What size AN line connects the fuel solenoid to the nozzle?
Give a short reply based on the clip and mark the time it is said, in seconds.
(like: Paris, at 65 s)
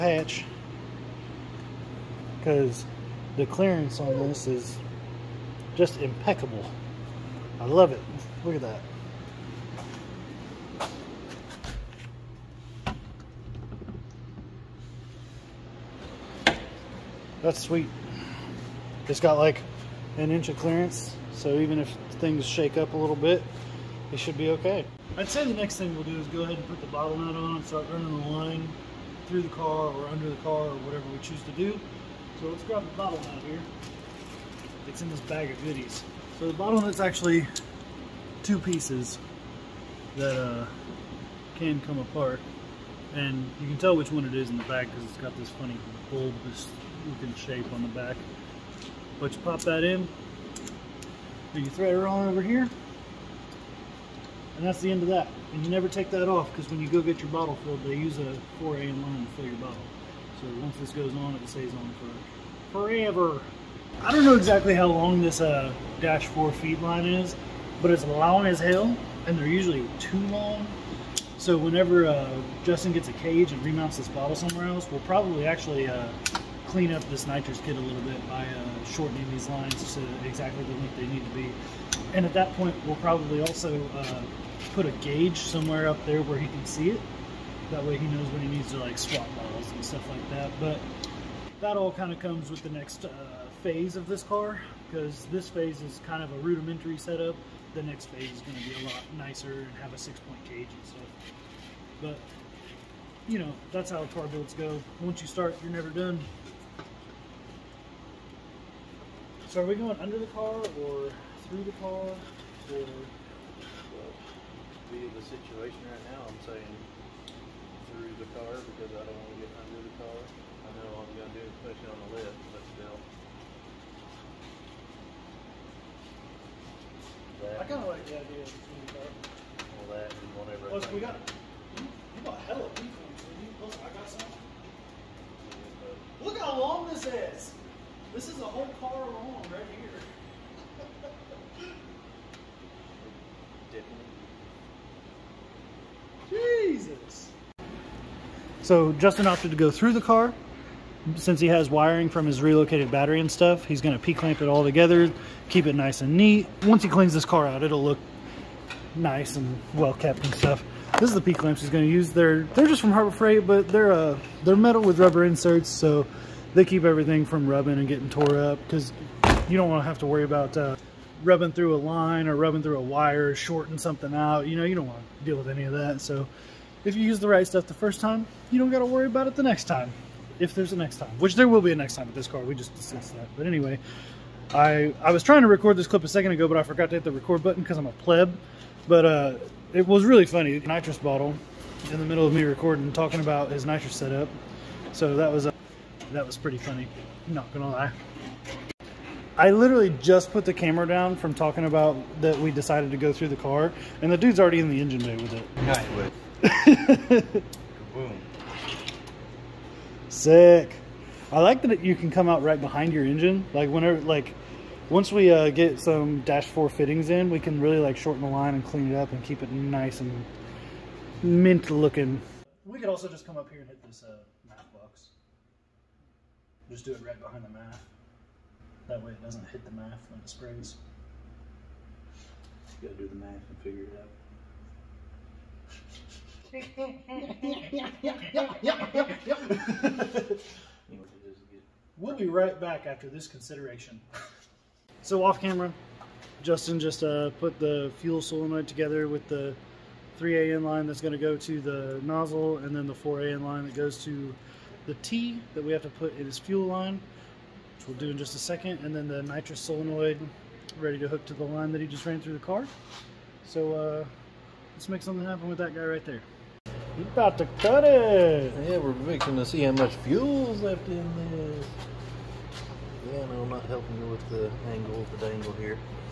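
3 AN, at 250 s.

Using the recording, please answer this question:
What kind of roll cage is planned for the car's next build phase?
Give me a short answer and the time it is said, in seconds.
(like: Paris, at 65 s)
six-point cage, at 99 s.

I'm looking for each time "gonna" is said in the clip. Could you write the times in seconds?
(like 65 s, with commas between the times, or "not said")
153 s, 161 s.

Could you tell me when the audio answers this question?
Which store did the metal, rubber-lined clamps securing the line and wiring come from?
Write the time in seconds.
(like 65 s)
162 s.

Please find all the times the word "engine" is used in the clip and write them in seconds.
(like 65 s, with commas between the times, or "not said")
204 s, 213 s.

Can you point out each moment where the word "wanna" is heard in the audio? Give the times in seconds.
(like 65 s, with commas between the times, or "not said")
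169 s, 174 s.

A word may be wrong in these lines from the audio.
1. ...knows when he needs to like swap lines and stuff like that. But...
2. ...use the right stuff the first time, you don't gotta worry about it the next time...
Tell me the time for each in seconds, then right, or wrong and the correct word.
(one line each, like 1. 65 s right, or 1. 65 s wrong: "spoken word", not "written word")
1. 88 s wrong: "bottles", not "lines"
2. 177 s right.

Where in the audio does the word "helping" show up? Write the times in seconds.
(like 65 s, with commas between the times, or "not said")
273 s.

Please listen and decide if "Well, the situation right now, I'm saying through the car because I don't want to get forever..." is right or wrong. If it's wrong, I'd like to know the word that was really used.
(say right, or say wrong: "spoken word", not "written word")
wrong: "under", not "forever".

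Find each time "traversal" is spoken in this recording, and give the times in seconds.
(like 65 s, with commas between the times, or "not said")
not said.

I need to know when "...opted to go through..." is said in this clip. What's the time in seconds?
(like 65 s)
149 s.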